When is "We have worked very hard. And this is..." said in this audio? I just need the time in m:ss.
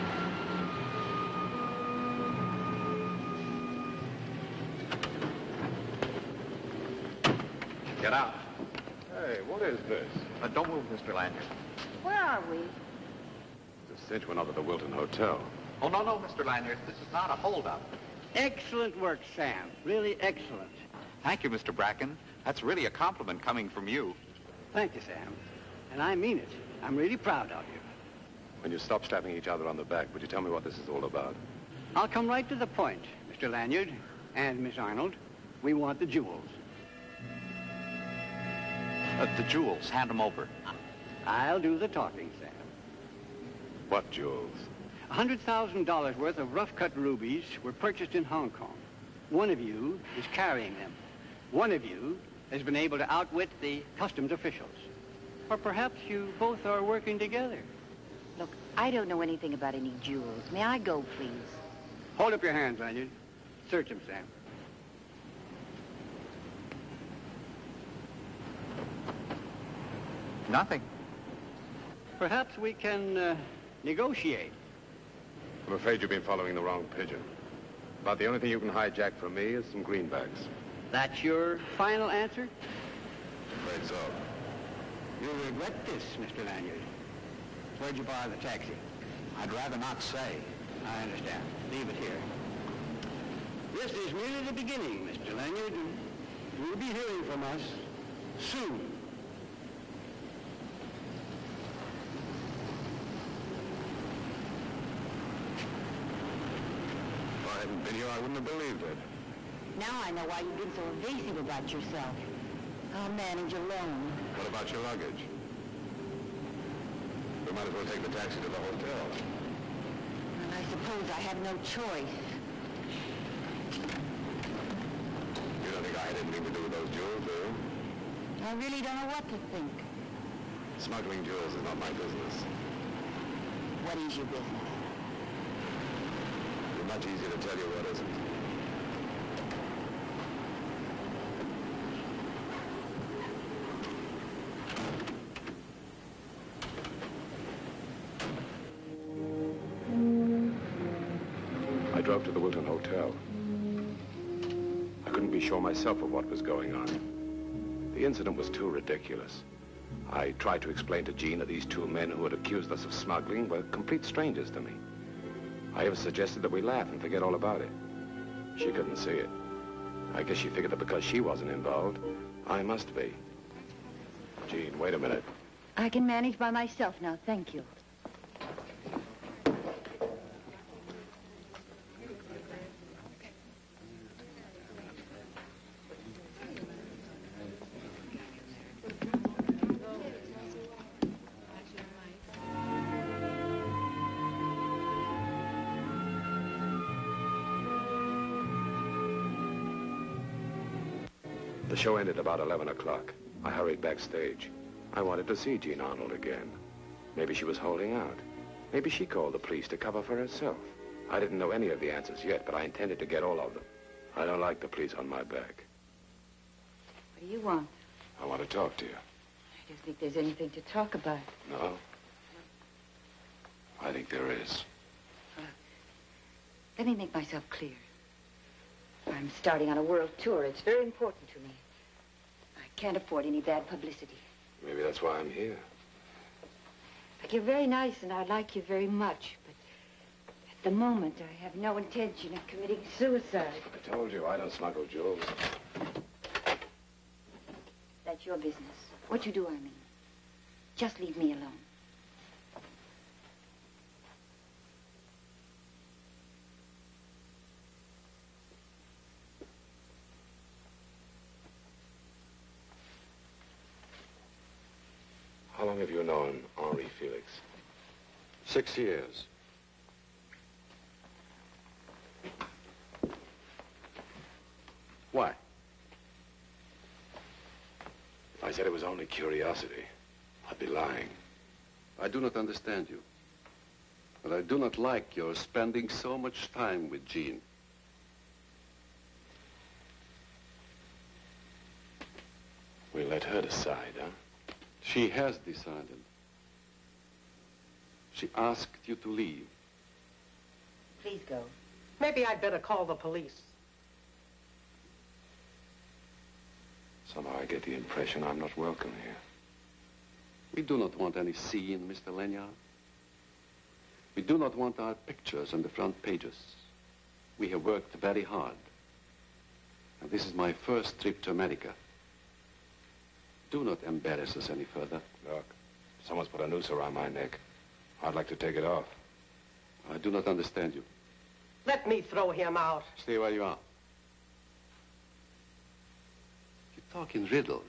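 5:17.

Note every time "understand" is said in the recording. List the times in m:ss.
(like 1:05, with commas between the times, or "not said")
1:31, 4:42, 5:30.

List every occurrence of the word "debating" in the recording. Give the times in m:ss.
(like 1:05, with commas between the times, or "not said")
not said.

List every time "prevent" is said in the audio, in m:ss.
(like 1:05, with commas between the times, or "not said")
not said.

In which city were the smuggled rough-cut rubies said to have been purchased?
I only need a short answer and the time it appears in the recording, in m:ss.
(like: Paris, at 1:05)
Hong Kong, at 0:48.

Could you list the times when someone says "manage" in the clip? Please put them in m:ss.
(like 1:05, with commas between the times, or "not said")
1:53, 2:56.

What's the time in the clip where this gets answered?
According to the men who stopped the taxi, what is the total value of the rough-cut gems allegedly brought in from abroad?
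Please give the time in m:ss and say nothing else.
0:45.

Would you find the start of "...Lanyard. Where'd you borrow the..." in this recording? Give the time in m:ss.
1:26.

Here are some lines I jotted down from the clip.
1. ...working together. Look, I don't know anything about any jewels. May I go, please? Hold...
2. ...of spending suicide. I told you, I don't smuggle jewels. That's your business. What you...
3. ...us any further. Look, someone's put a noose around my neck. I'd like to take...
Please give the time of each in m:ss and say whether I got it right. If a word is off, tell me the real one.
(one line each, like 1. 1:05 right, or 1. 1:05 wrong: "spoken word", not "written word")
1. 0:56 right
2. 4:02 wrong: "committing", not "spending"
3. 5:24 right.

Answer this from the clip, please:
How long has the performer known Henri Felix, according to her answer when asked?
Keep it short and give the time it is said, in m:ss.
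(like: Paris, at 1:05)
6 years, at 4:28.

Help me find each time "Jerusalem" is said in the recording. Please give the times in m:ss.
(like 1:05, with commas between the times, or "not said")
not said.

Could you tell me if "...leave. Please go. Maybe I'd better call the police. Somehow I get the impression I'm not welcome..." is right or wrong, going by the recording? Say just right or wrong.
right.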